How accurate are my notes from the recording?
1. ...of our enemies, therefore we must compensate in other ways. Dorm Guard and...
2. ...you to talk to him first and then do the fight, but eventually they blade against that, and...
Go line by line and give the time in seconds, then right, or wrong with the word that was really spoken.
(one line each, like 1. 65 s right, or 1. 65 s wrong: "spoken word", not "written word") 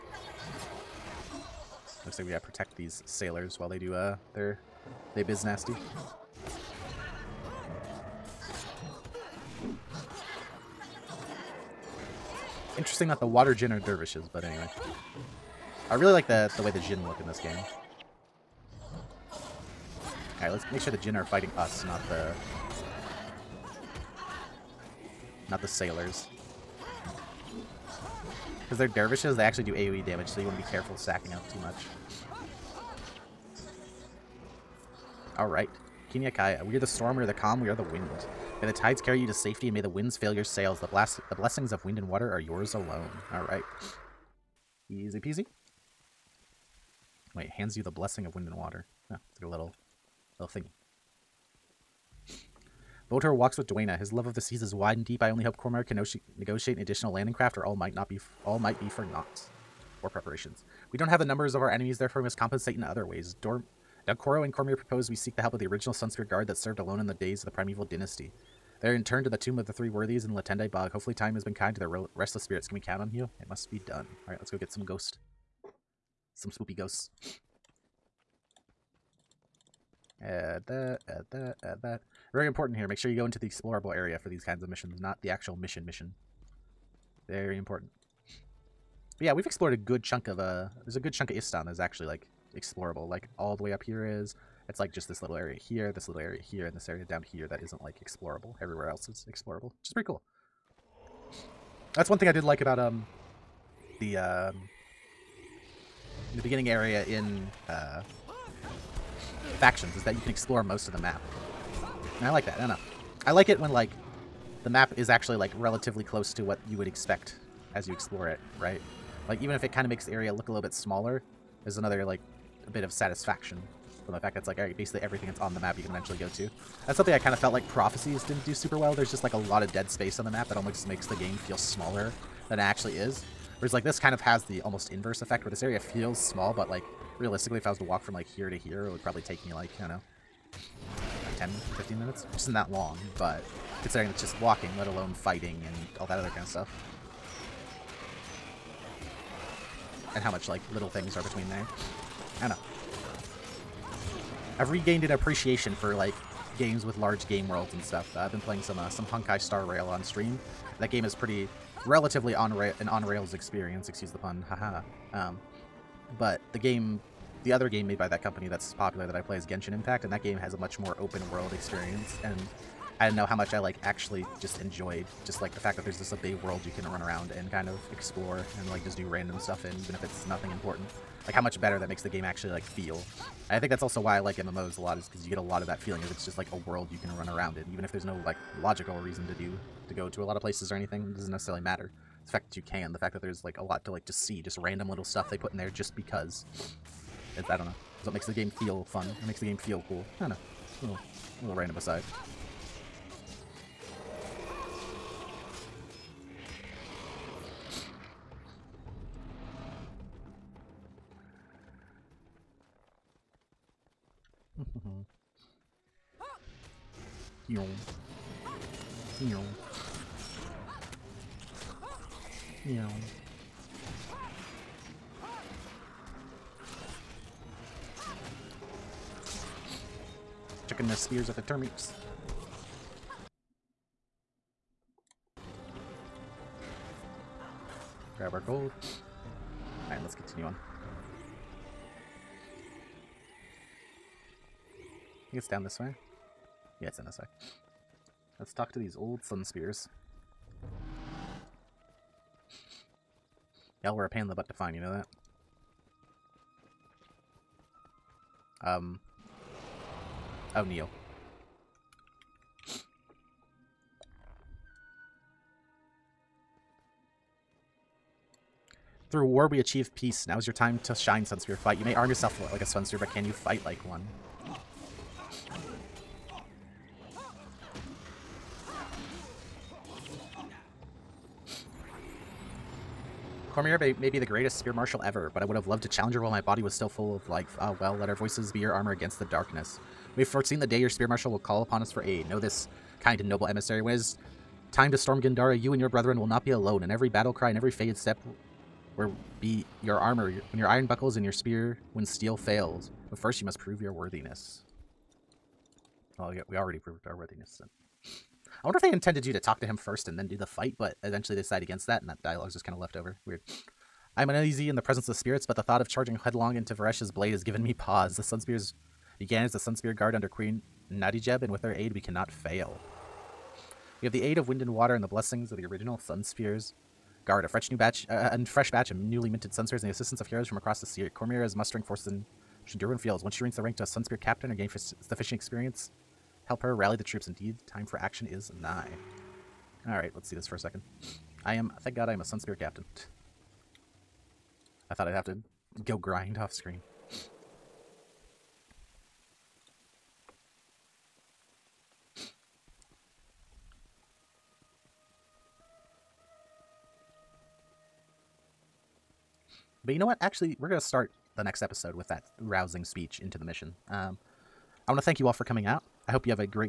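1. 61 s wrong: "Dunkoro", not "Guard"
2. 309 s wrong: "decide", not "blade".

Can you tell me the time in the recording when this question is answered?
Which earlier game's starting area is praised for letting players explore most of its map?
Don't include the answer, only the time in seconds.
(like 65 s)
109 s.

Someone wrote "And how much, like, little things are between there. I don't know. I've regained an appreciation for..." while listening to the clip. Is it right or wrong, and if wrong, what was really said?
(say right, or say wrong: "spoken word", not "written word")
right.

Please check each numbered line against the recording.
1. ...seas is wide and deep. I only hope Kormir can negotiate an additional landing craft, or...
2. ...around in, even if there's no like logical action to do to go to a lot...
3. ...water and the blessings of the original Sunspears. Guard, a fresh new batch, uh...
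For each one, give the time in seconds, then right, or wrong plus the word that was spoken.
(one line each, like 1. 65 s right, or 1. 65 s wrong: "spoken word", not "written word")
1. 54 s right
2. 187 s wrong: "reason", not "action"
3. 324 s right.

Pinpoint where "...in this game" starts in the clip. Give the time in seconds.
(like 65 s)
17 s.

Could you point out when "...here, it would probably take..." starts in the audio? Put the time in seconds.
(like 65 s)
138 s.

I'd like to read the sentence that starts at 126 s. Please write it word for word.
That's something I kind of felt like Prophecies didn't do super well.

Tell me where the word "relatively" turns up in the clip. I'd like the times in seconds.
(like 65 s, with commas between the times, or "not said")
115 s, 161 s.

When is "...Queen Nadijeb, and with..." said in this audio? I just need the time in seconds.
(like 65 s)
320 s.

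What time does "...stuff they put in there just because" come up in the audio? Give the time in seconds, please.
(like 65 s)
195 s.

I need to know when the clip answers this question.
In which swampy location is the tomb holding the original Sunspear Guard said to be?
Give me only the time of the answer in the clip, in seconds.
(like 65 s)
70 s.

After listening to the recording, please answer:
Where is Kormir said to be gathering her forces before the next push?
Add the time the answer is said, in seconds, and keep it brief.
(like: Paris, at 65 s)
Shindurwin Fields, at 332 s.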